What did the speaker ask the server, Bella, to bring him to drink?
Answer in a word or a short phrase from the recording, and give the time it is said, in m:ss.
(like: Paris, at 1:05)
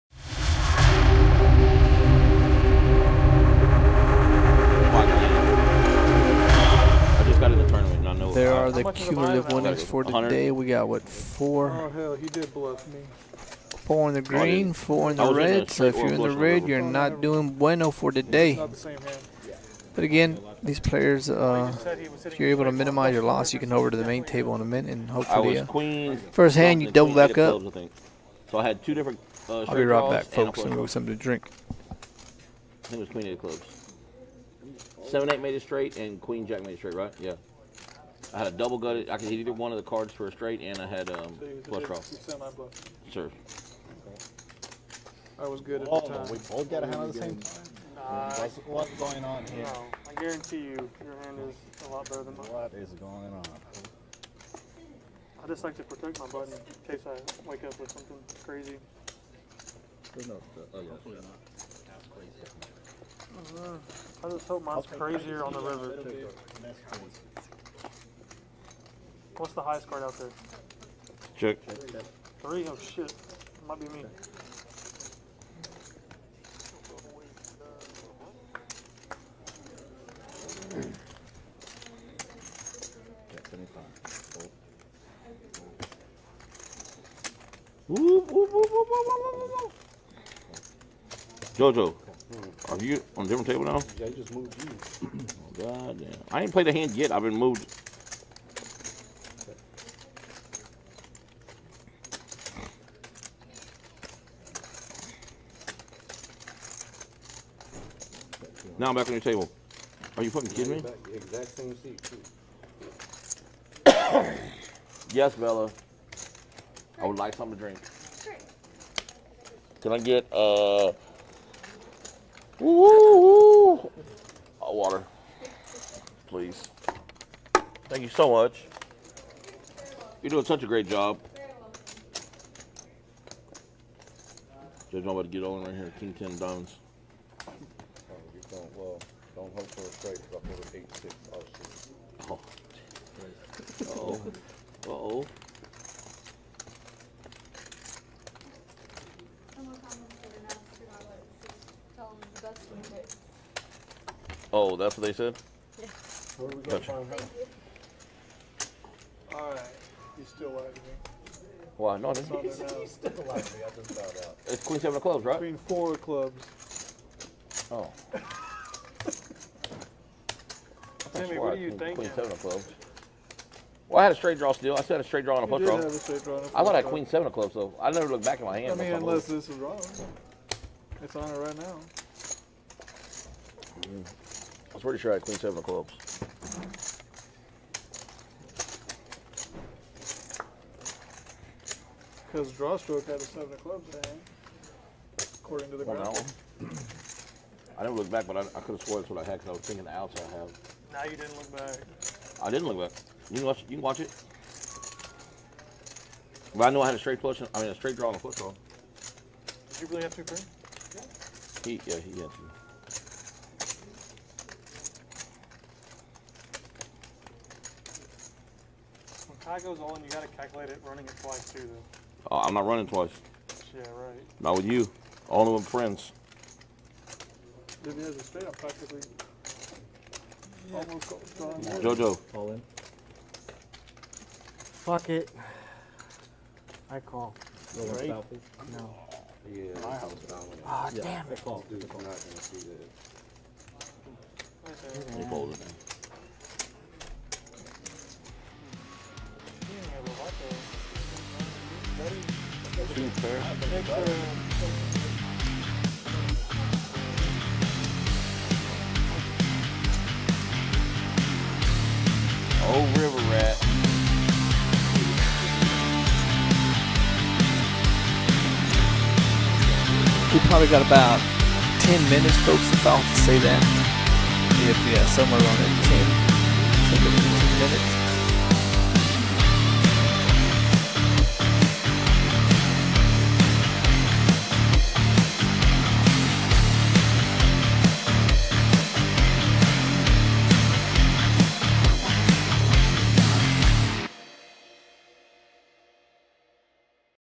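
water, at 2:02.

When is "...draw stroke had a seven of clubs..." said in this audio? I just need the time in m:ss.
3:12.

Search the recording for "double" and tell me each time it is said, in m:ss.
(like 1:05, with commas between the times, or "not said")
0:26, 0:38.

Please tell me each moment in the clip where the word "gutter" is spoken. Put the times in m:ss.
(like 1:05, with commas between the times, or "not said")
0:38.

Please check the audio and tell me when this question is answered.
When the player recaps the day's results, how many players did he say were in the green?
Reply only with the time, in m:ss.
0:13.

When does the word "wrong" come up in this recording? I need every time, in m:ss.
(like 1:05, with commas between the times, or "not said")
2:59.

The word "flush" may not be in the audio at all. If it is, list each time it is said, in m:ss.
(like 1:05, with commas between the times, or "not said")
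0:41, 3:27.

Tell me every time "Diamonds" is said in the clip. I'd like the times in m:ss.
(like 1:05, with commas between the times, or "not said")
2:16.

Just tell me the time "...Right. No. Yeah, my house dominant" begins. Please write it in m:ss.
3:57.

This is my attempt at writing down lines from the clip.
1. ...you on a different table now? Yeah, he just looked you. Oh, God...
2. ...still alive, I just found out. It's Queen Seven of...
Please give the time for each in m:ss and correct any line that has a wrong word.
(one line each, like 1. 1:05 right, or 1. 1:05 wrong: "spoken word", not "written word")
1. 1:32 wrong: "moved", not "looked"
2. 2:42 right.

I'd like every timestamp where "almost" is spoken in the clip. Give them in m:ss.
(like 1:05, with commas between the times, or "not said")
3:50.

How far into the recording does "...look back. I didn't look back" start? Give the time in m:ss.
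3:21.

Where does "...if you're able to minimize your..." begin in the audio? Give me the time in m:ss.
0:22.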